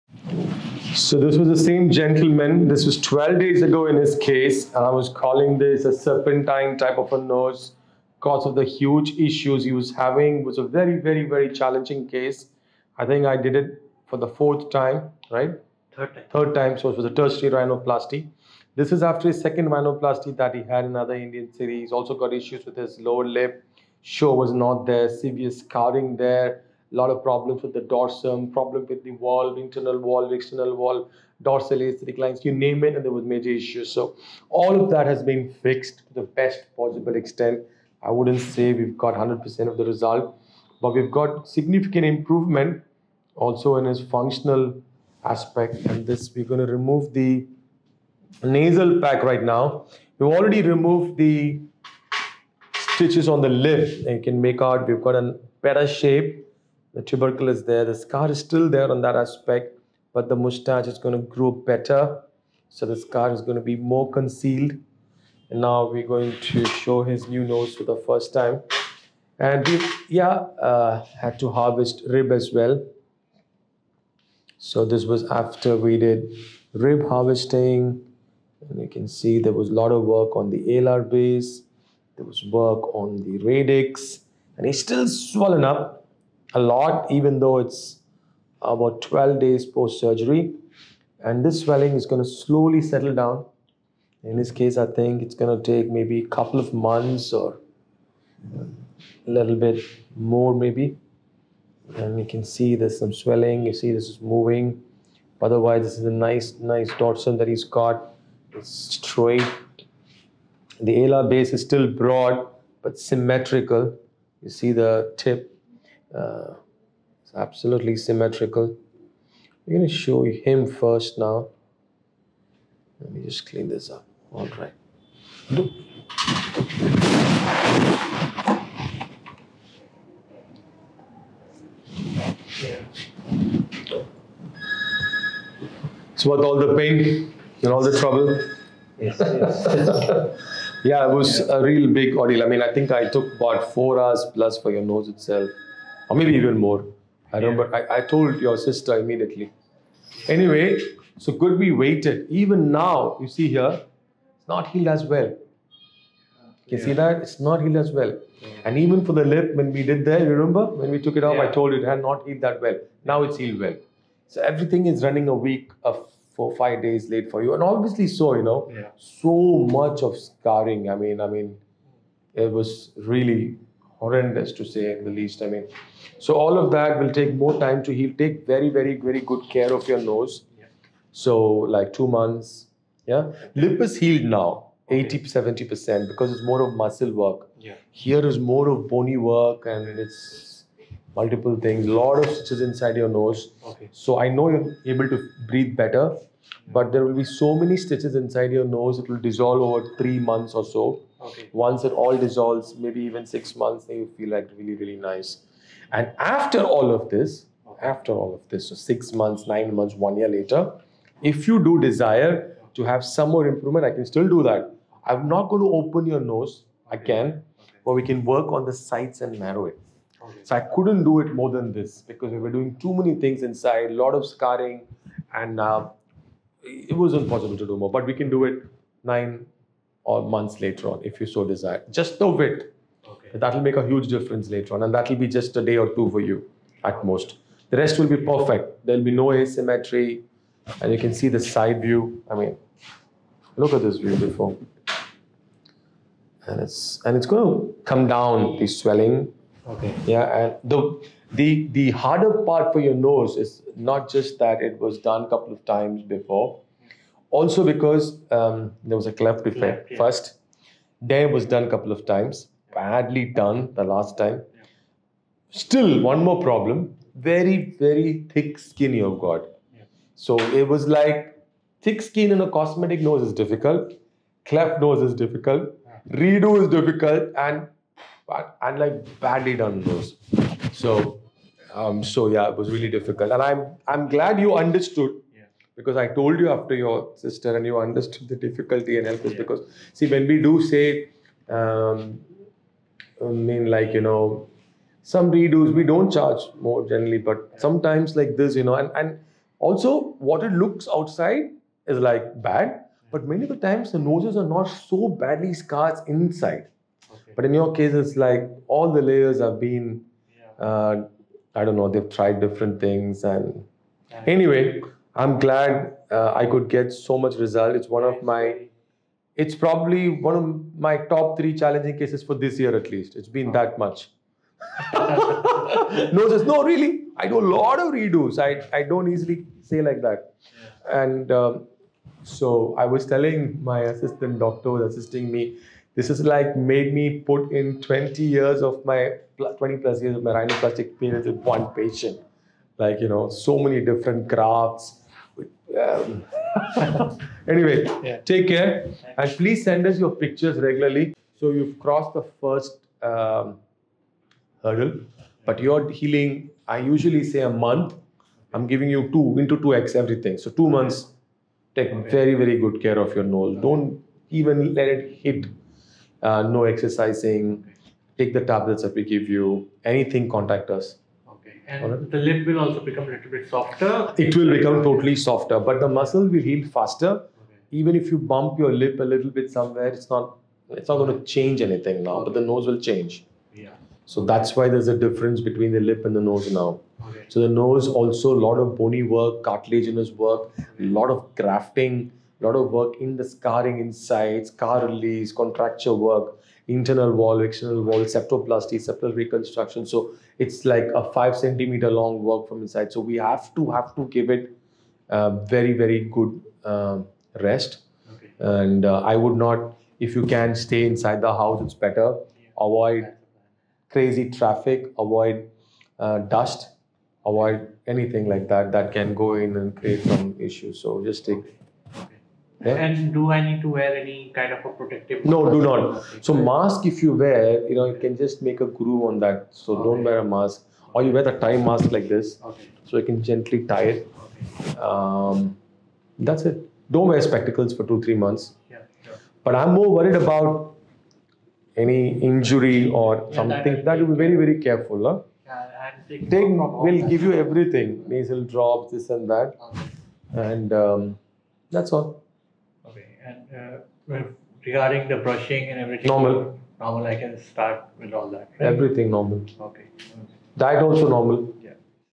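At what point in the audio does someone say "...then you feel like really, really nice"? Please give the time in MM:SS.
03:23.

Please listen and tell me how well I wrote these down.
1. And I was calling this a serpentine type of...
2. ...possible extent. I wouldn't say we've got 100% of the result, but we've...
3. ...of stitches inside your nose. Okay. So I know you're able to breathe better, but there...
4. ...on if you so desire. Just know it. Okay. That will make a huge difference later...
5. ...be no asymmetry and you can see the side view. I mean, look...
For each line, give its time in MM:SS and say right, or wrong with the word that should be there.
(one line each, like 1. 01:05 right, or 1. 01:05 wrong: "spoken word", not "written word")
1. 00:04 right
2. 00:36 right
3. 03:12 right
4. 03:50 right
5. 03:59 right.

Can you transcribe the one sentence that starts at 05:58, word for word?
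I'm giving you two into 2x everything.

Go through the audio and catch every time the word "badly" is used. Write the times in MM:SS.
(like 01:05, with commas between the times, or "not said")
04:22, 04:39, 05:05.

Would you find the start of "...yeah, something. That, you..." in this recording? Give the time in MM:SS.
07:23.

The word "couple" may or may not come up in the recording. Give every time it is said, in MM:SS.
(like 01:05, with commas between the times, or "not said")
01:36, 04:15, 04:21.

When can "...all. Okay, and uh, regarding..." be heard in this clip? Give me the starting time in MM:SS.
07:31.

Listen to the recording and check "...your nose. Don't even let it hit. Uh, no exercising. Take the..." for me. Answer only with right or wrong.
right.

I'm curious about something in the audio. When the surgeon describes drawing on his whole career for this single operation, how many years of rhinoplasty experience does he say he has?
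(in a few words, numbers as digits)
20 plus years.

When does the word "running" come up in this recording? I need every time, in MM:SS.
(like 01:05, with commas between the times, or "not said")
02:45.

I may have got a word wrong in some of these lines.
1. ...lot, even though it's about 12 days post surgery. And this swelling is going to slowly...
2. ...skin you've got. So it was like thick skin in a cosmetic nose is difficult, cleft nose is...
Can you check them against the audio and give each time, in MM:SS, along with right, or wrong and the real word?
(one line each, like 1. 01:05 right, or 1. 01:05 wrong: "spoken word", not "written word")
1. 01:26 right
2. 04:28 right.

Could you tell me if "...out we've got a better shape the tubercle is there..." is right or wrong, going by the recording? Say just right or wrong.
right.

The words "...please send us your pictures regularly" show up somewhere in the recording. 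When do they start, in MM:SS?
05:49.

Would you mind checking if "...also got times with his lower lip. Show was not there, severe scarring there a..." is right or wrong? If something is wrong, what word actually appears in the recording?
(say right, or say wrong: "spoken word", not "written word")
wrong: "issues", not "times".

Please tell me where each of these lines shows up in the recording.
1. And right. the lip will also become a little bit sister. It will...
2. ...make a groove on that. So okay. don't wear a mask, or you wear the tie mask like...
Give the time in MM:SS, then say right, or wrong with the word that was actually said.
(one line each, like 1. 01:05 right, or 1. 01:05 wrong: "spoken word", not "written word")
1. 06:11 wrong: "softer", not "sister"
2. 07:08 right.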